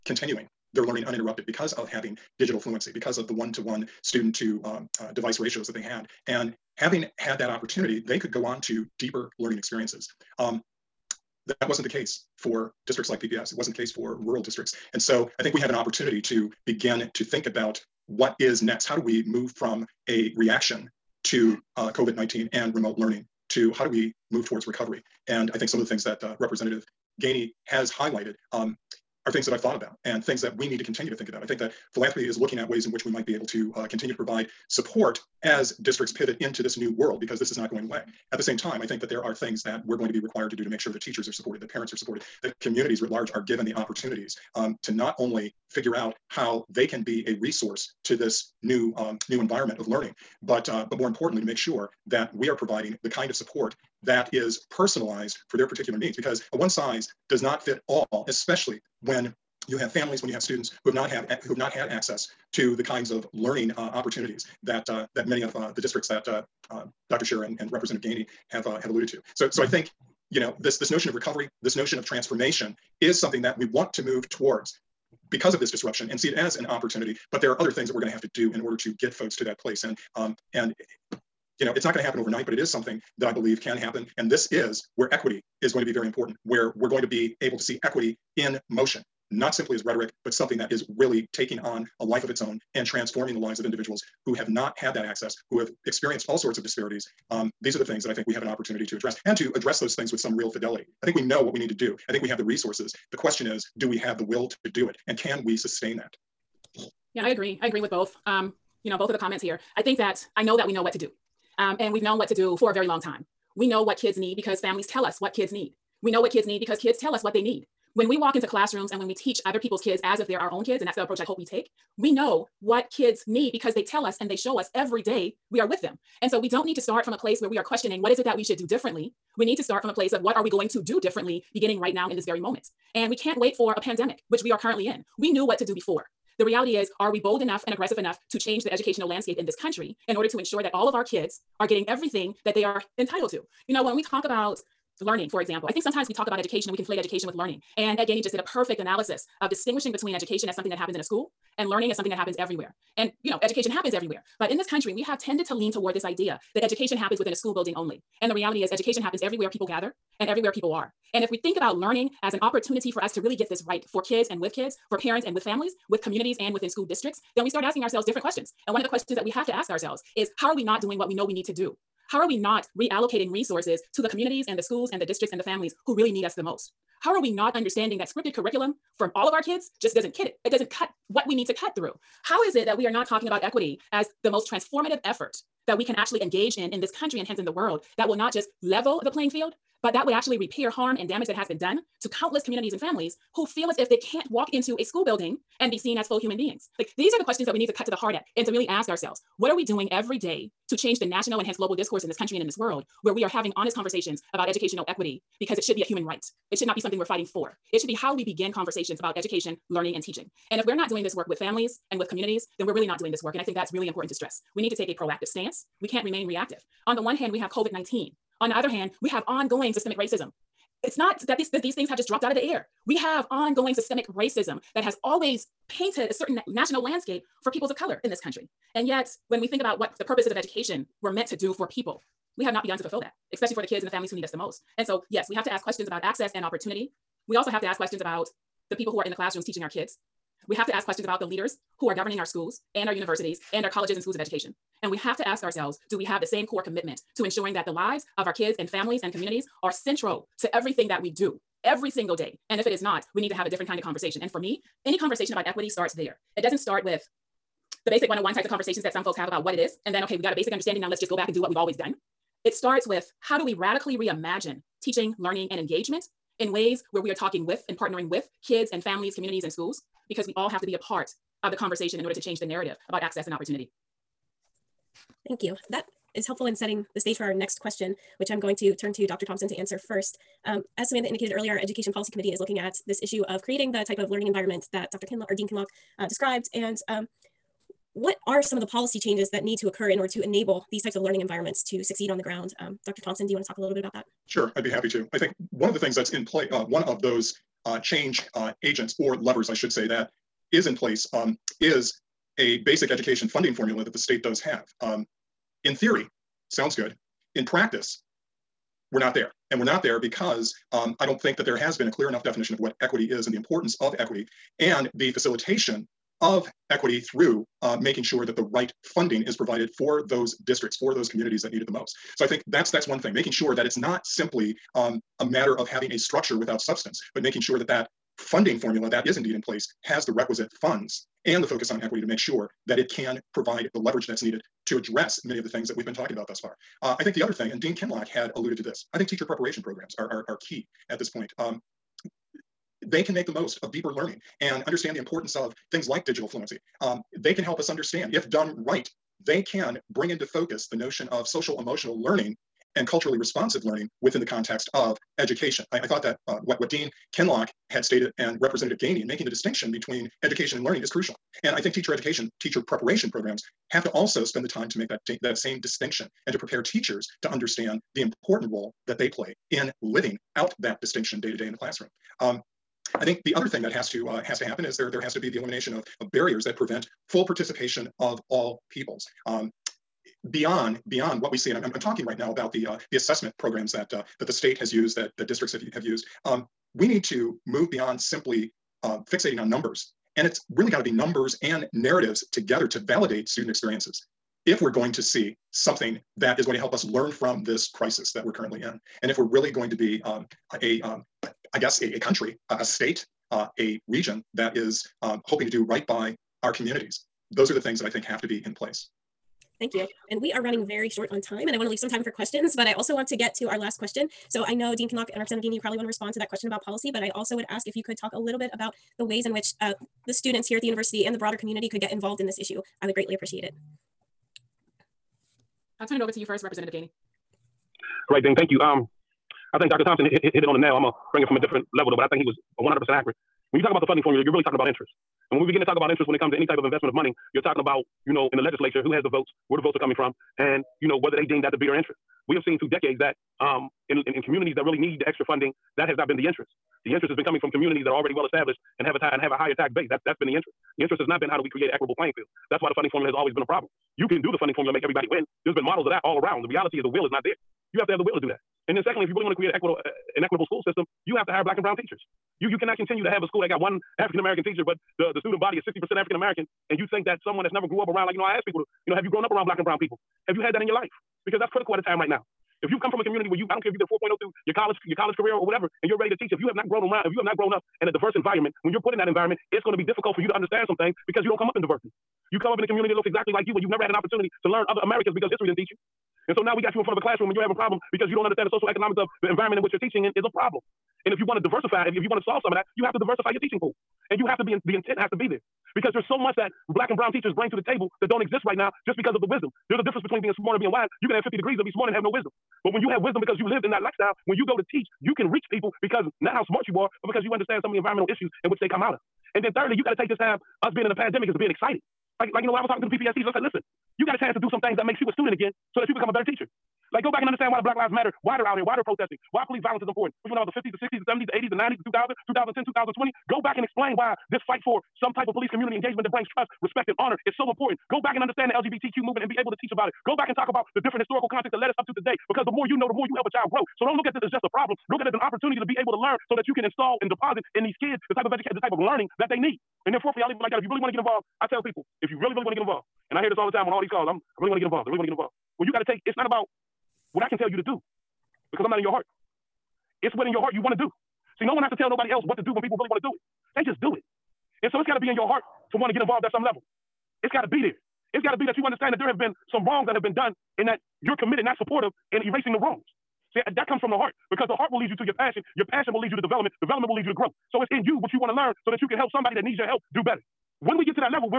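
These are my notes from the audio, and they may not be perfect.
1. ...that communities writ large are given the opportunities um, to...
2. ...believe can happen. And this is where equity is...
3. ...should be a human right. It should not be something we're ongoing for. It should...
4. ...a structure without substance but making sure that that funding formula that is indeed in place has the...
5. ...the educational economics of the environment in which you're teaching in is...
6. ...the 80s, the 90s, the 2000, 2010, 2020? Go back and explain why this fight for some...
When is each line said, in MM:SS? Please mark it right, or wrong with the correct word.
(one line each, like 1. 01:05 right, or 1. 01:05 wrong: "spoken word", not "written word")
1. 00:42 right
2. 01:23 right
3. 03:25 wrong: "fighting", not "ongoing"
4. 05:25 right
5. 08:08 wrong: "social", not "educational"
6. 08:41 right.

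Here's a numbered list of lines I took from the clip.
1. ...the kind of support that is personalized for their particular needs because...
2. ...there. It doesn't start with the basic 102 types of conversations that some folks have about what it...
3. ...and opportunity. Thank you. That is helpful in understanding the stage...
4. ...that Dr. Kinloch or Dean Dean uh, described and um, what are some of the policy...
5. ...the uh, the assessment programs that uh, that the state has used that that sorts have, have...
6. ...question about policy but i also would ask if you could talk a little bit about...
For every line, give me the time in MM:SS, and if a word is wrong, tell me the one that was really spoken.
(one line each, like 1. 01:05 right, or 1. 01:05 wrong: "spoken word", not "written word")
1. 00:53 right
2. 04:15 wrong: "101", not "102"
3. 04:33 wrong: "setting", not "understanding"
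4. 04:44 wrong: "Kinloch", not "Dean"
5. 06:22 wrong: "districts", not "sorts"
6. 06:56 right.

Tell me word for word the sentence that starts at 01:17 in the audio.
But there are other things that we're going to have to do in order to get folks to that place.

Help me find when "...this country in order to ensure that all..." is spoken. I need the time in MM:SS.
02:19.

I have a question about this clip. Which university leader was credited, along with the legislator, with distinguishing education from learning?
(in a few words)
Ed Gainey.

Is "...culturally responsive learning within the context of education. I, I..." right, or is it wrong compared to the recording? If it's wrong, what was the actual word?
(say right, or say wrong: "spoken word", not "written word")
right.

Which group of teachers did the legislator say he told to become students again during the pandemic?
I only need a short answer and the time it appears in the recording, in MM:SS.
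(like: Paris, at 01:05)
PPS teachers, at 08:32.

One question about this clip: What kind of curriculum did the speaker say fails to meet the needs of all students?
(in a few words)
scripted curriculum.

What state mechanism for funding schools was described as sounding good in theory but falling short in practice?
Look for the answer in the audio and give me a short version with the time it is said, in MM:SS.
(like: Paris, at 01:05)
basic education funding formula, at 05:02.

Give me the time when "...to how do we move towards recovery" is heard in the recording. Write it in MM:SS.
00:23.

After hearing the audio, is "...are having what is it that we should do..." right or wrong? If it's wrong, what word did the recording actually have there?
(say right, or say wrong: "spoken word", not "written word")
wrong: "questioning", not "having".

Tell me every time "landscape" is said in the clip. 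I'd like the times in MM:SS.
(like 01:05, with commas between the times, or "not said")
02:19, 03:46.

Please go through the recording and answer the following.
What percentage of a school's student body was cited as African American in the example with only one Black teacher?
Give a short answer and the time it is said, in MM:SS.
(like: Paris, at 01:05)
60%, at 07:45.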